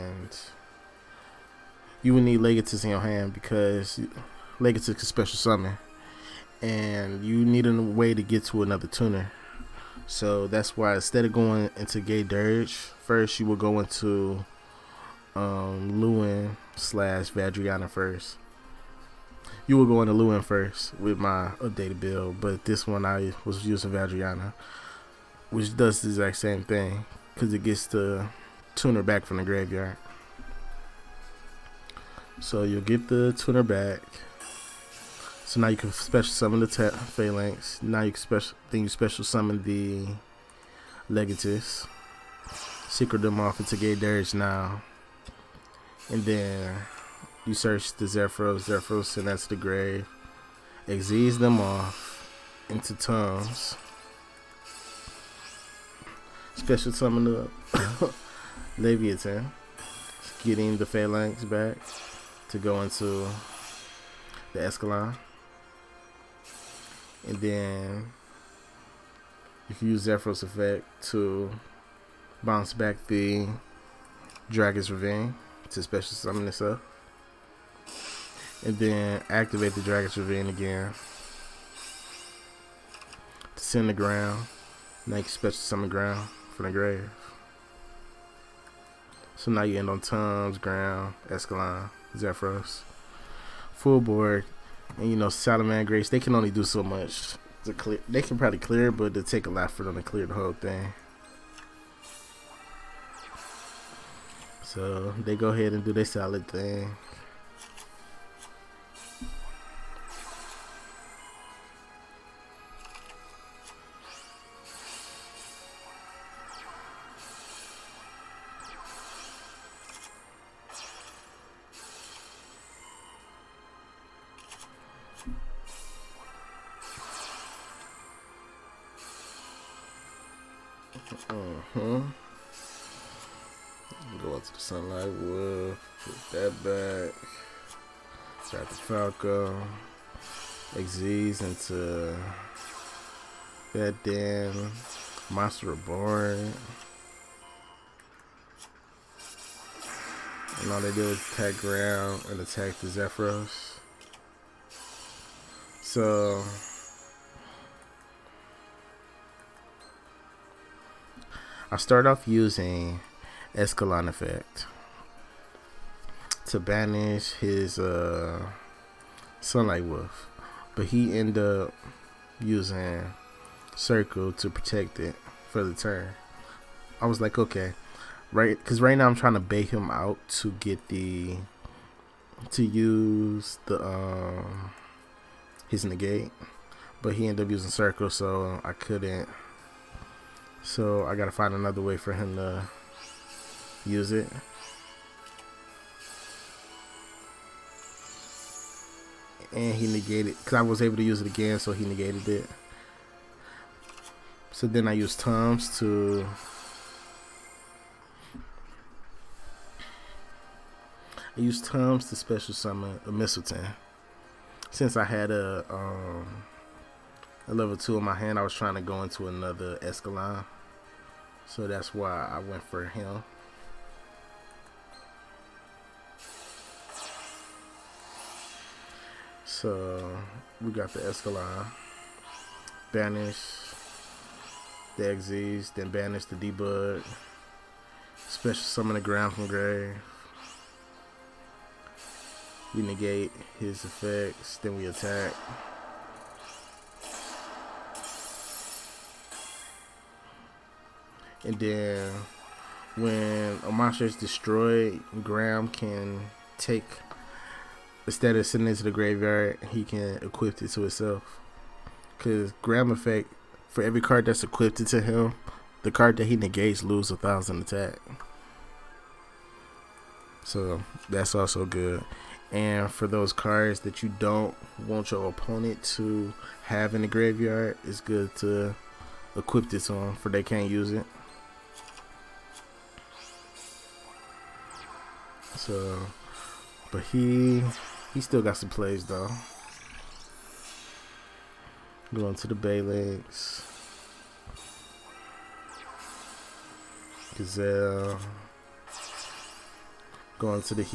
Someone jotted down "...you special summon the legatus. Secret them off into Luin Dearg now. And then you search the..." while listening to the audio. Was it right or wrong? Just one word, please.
wrong.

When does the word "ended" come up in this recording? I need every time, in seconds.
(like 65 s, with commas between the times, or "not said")
171 s, 187 s.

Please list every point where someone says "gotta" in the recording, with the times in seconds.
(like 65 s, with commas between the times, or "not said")
191 s.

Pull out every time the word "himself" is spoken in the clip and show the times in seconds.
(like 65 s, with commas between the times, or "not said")
260 s.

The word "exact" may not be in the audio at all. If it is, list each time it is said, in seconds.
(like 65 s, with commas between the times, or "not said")
26 s.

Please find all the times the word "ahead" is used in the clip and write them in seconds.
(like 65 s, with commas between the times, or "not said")
105 s.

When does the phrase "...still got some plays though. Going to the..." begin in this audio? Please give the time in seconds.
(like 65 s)
288 s.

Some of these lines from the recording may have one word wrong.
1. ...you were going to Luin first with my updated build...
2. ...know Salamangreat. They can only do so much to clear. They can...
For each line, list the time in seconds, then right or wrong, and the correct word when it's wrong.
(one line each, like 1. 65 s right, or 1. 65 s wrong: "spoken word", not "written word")
1. 19 s right
2. 95 s right.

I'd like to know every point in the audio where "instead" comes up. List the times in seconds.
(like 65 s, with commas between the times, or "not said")
10 s, 258 s.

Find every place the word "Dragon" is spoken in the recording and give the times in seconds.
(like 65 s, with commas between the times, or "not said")
74 s, 79 s.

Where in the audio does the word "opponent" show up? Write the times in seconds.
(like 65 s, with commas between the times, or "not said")
275 s.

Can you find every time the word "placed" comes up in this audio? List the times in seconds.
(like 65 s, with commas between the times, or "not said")
not said.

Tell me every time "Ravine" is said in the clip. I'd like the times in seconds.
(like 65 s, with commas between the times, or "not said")
74 s, 80 s.